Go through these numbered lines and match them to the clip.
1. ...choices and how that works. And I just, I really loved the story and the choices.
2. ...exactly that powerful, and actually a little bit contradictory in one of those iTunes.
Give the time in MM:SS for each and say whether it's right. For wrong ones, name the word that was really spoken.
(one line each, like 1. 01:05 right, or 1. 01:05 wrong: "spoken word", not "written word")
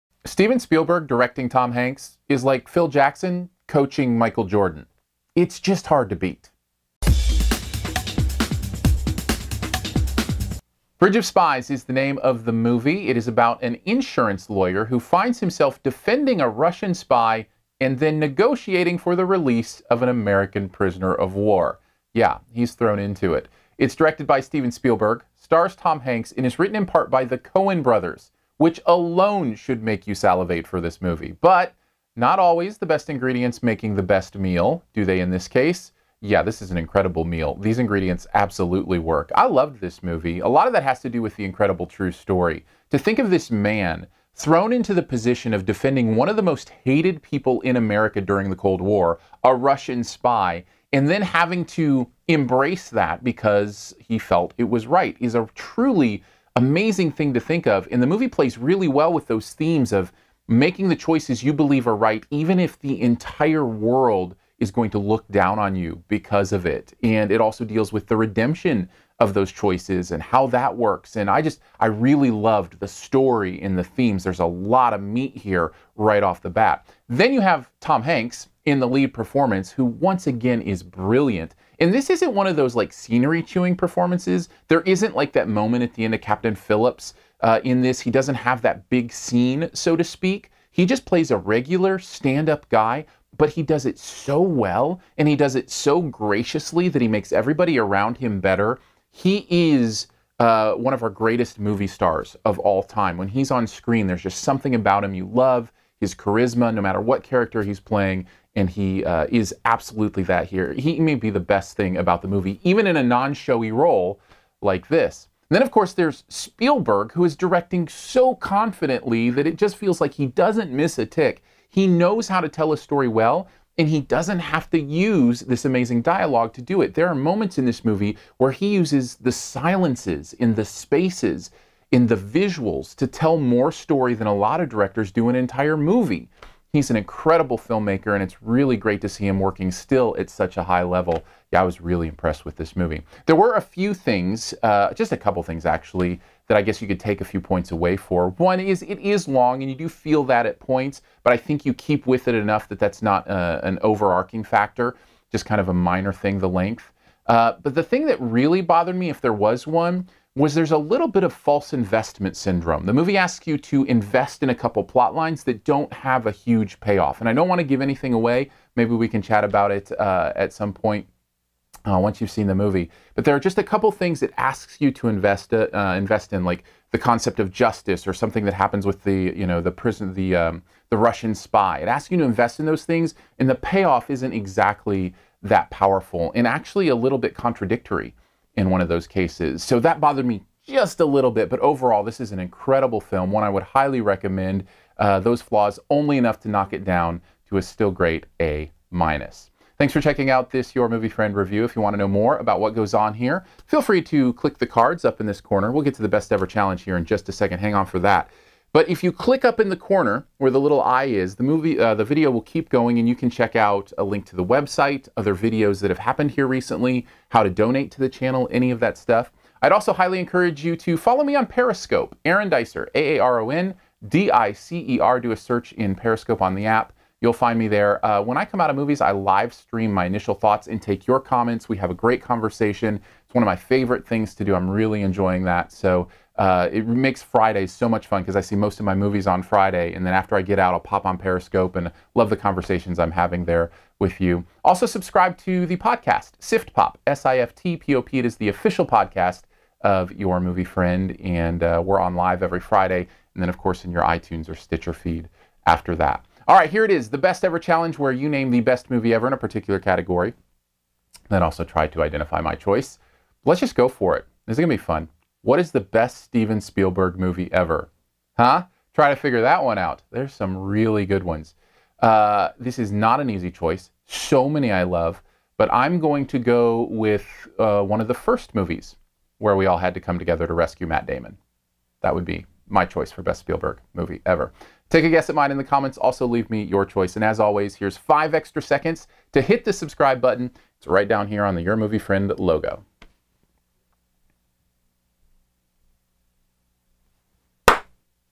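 1. 01:09 wrong: "themes", not "choices"
2. 03:04 wrong: "cases", not "iTunes".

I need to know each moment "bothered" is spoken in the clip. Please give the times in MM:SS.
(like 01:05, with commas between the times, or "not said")
02:38, 03:09.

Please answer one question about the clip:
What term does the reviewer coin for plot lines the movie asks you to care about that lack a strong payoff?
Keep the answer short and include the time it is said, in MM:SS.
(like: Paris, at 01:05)
false investment syndrome, at 02:41.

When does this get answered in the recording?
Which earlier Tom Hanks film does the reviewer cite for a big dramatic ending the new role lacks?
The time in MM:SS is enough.
01:26.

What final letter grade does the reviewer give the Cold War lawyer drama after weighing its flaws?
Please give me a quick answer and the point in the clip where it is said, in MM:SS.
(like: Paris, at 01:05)
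A minus, at 03:18.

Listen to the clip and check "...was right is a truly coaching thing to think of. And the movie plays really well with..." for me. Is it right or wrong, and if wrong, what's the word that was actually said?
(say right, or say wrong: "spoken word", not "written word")
wrong: "amazing", not "coaching".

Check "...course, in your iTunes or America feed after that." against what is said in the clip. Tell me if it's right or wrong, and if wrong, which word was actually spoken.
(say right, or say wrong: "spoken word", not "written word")
wrong: "Stitcher", not "America".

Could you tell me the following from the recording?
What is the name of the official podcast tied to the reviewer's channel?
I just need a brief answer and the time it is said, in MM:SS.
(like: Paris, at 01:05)
SiftPop, at 04:06.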